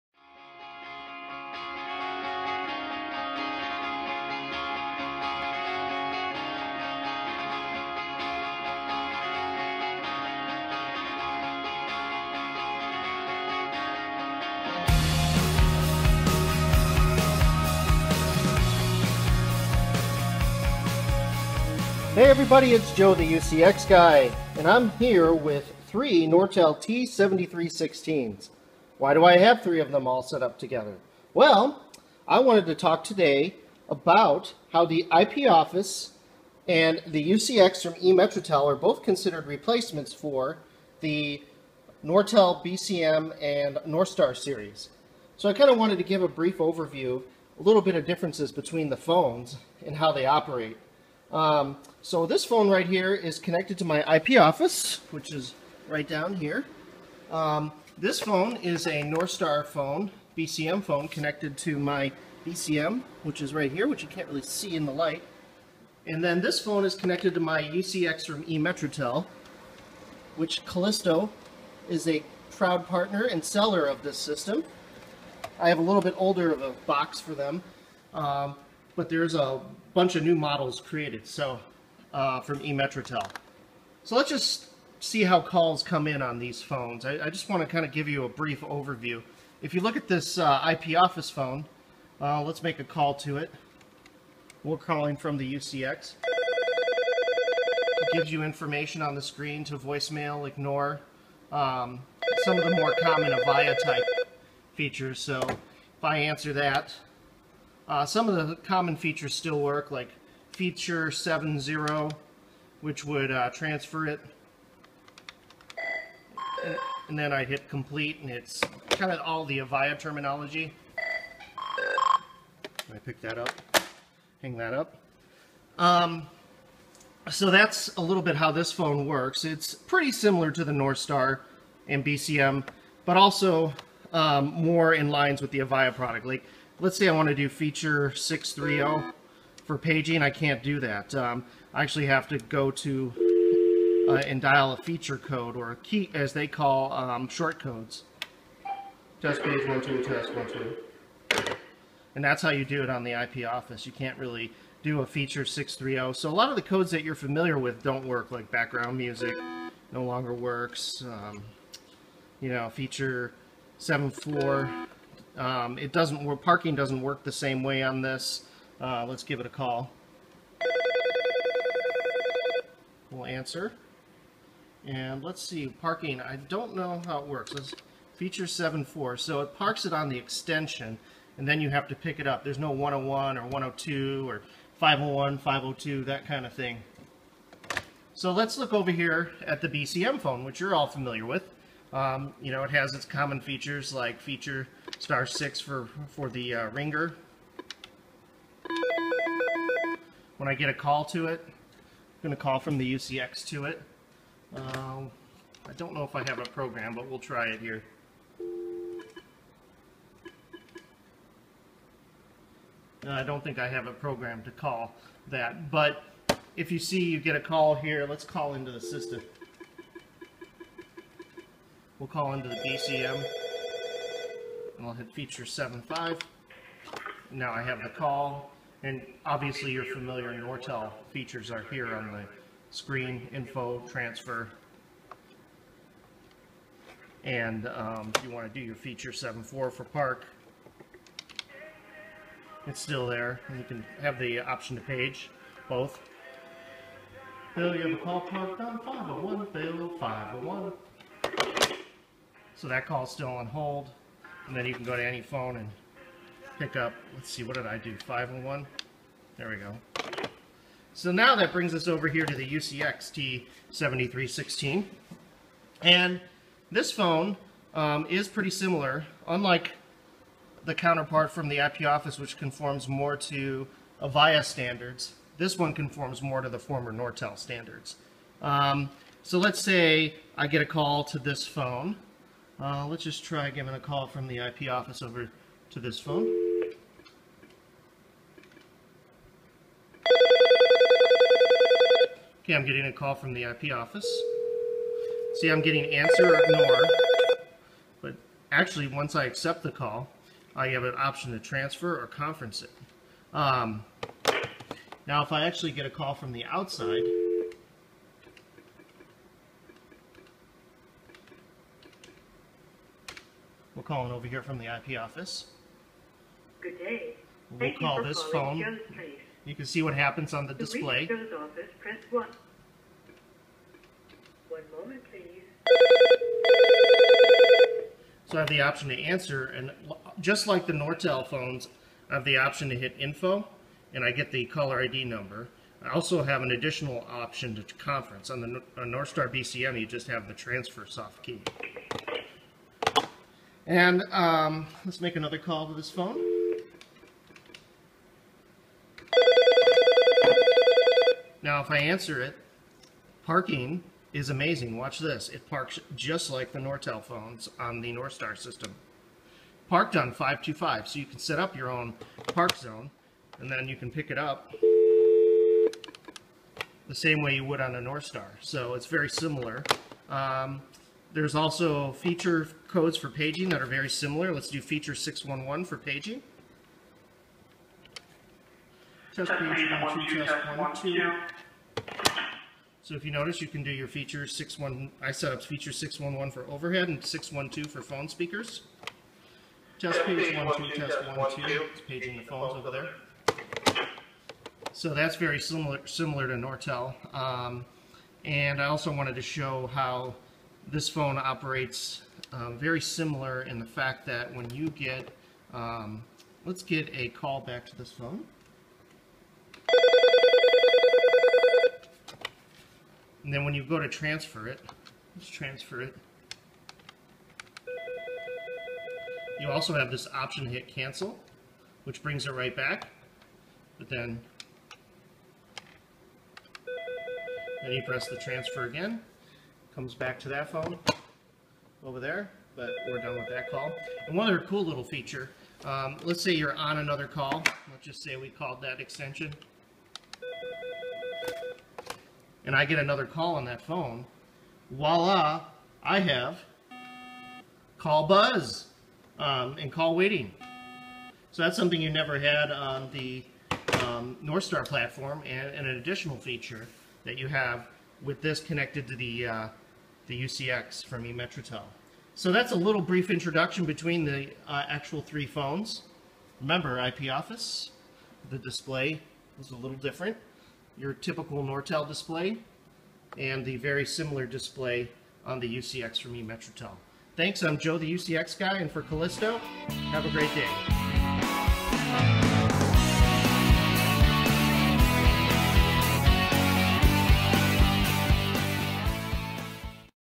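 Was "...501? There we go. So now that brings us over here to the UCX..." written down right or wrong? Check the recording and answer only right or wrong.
right.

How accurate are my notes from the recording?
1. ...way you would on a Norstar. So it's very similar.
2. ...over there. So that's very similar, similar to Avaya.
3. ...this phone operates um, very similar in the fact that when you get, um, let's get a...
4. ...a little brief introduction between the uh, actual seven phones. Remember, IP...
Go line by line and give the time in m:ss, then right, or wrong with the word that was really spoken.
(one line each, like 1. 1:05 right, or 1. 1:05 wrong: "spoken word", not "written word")
1. 6:07 right
2. 6:32 wrong: "Nortel", not "Avaya"
3. 6:40 right
4. 7:42 wrong: "three", not "seven".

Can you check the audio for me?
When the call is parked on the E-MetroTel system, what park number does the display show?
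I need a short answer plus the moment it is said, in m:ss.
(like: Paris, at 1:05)
525, at 6:00.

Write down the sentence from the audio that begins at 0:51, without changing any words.
Um, so this phone right here is connected to my IP office, which is right down here.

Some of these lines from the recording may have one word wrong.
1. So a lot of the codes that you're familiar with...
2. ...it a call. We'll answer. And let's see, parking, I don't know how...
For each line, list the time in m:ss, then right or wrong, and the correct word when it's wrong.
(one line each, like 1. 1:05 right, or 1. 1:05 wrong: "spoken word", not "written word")
1. 2:36 right
2. 2:49 right.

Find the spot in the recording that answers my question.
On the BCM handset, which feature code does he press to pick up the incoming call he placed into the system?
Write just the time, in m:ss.
3:45.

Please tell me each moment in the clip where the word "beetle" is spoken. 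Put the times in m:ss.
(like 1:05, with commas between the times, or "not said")
not said.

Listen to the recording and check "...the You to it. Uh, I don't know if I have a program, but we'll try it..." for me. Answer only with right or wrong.
wrong.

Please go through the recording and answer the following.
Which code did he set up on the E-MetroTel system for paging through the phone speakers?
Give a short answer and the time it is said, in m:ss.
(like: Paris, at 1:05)
612, at 6:27.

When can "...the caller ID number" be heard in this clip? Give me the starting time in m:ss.
5:34.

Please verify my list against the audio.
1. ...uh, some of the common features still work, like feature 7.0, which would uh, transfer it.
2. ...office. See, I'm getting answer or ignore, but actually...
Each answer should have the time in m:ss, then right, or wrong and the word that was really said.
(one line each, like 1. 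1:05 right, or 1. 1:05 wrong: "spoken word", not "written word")
1. 1:47 right
2. 4:53 right.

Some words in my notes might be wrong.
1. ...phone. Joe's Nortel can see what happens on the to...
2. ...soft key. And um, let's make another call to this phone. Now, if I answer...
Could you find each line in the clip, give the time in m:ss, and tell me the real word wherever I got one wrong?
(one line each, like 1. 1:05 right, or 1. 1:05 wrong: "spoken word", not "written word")
1. 5:18 wrong: "You", not "Nortel"
2. 5:40 right.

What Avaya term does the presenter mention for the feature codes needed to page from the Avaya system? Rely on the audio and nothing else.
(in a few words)
short codes.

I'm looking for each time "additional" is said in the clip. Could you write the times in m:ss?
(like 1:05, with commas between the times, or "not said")
5:36, 7:35.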